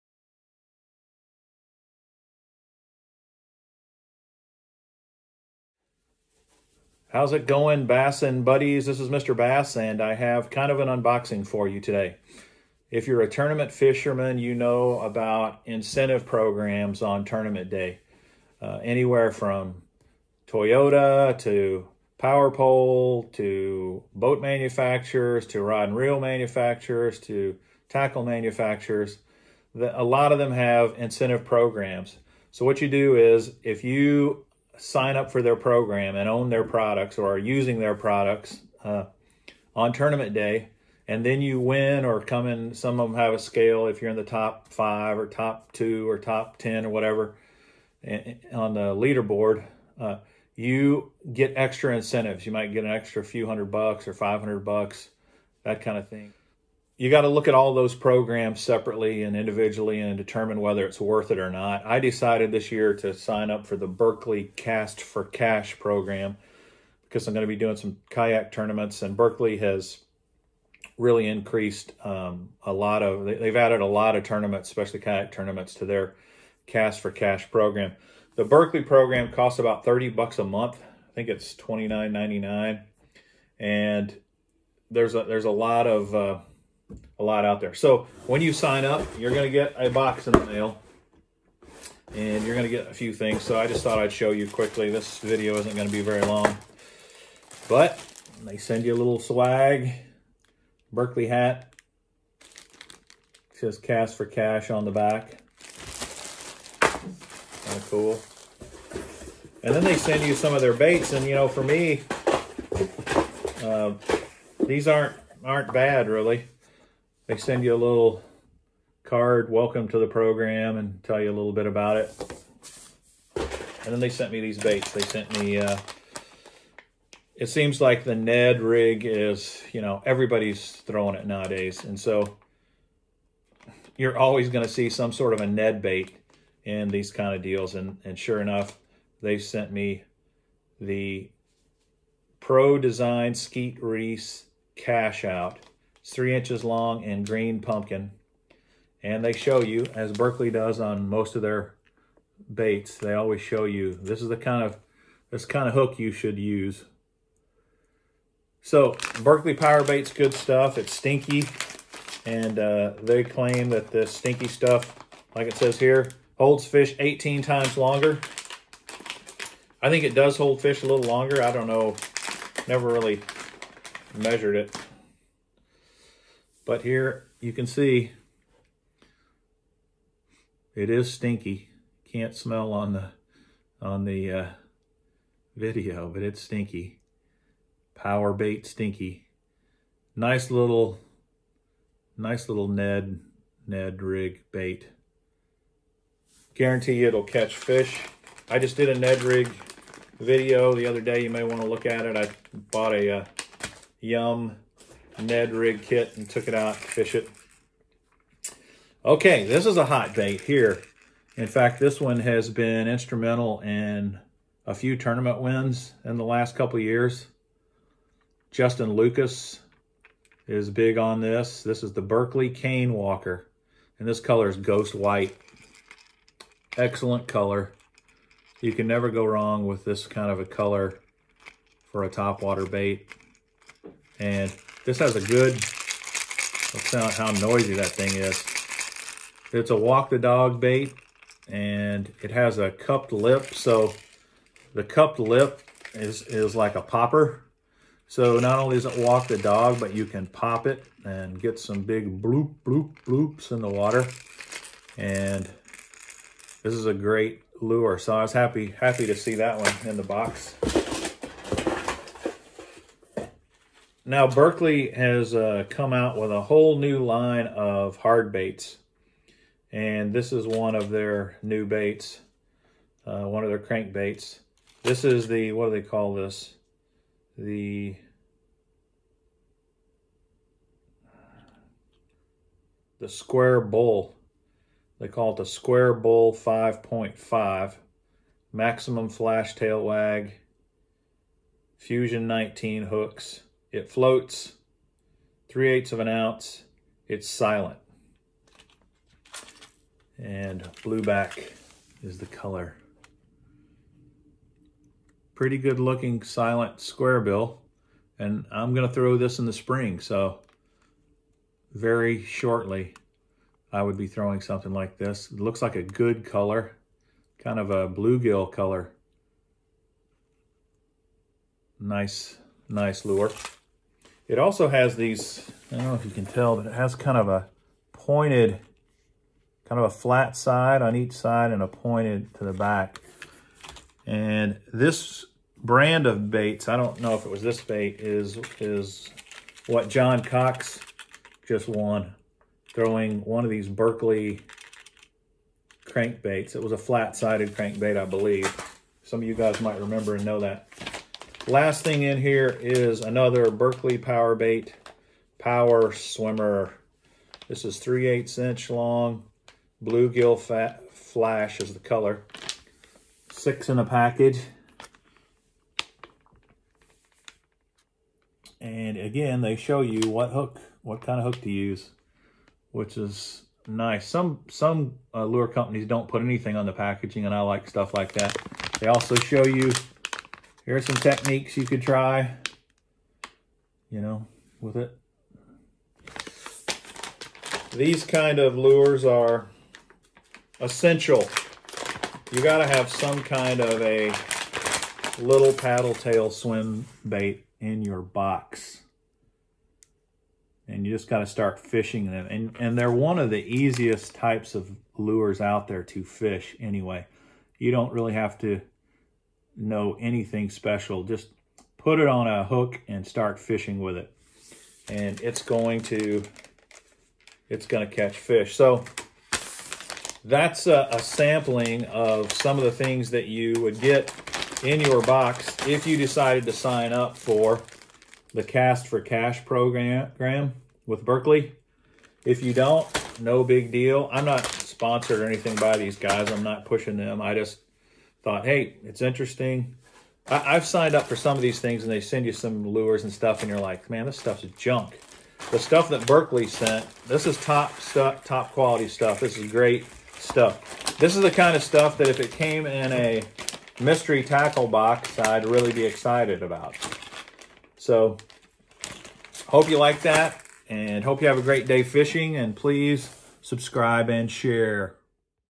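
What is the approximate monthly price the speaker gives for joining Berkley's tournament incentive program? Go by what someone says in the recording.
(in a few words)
$29.99.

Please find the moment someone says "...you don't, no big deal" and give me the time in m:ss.
7:12.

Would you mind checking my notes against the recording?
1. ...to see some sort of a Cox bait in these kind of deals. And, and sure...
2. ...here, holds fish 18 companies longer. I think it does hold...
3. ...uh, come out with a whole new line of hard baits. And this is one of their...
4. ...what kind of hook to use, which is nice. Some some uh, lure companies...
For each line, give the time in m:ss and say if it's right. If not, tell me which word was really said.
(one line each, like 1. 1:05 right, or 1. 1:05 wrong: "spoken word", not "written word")
1. 2:14 wrong: "Ned", not "Cox"
2. 2:45 wrong: "times", not "companies"
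3. 4:25 right
4. 6:10 right.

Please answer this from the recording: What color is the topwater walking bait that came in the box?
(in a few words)
ghost white.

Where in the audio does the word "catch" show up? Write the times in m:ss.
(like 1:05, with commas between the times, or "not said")
3:17, 6:57.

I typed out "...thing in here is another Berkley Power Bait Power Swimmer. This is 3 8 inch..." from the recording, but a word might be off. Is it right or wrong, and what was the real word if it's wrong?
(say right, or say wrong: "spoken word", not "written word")
right.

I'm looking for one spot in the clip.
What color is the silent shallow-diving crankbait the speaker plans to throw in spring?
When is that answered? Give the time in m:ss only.
5:00.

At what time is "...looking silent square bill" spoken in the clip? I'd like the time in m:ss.
5:05.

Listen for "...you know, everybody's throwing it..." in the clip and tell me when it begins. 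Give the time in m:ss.
2:09.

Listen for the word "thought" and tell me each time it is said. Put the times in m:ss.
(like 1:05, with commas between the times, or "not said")
1:33, 7:18.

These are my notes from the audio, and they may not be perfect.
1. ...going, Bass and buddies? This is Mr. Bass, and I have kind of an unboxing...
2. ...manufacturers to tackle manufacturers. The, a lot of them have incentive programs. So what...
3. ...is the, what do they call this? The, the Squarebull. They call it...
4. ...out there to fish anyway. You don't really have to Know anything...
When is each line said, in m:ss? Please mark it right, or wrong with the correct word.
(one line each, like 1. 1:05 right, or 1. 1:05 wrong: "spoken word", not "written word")
1. 0:07 right
2. 0:26 right
3. 4:35 right
4. 6:45 right.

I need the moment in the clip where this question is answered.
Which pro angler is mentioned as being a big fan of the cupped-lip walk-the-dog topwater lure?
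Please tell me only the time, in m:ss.
3:38.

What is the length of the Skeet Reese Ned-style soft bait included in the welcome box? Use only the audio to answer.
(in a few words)
3 inches.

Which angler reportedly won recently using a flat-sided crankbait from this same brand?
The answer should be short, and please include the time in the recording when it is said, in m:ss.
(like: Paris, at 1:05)
John Cox, at 5:39.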